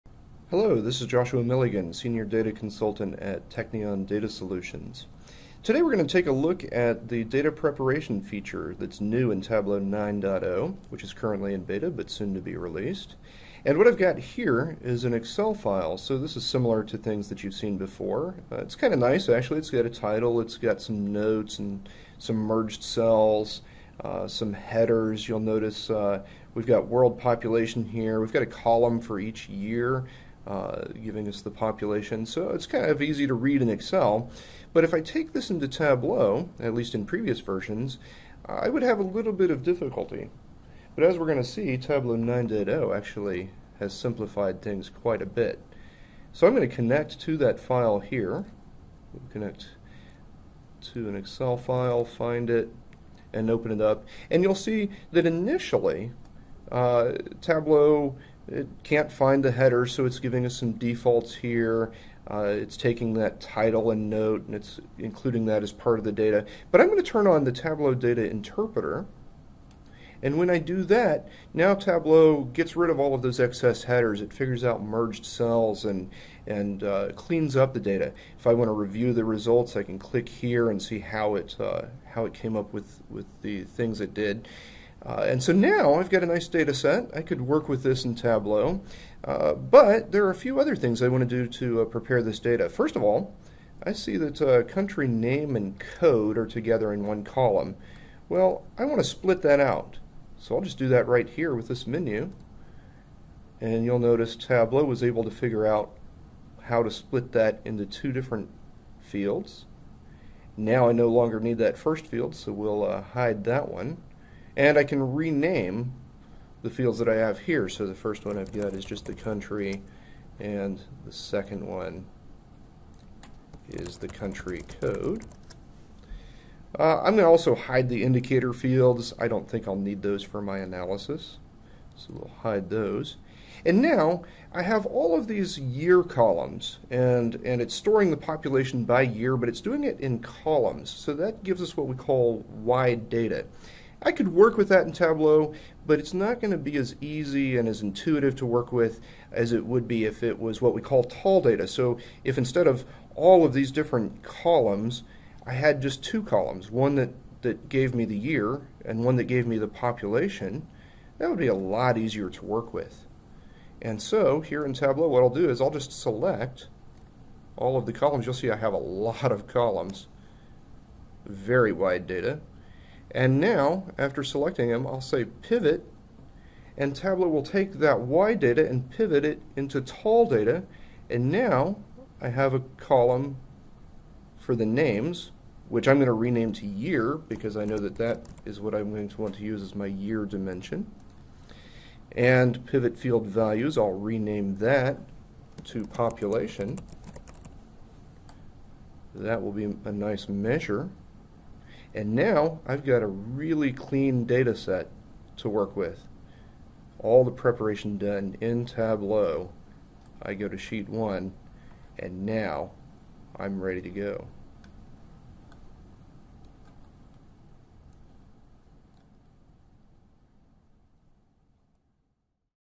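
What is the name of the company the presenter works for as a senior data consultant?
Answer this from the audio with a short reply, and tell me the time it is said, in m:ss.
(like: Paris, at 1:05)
Teknion Data Solutions, at 0:03.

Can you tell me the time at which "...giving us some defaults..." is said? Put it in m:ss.
1:00.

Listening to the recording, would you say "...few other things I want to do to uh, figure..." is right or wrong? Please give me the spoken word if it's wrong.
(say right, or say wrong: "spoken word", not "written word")
wrong: "prepare", not "figure".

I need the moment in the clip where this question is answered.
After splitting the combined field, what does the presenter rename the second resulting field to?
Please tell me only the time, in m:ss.
2:04.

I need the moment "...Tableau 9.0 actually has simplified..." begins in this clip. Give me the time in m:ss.
0:41.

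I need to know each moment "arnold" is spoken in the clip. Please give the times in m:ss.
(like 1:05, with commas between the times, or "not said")
not said.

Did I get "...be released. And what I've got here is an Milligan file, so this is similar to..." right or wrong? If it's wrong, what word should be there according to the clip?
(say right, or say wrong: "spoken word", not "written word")
wrong: "Excel", not "Milligan".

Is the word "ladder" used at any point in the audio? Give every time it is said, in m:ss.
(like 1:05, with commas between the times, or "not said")
not said.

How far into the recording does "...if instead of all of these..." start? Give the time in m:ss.
2:32.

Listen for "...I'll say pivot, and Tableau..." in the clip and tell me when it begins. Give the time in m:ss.
2:54.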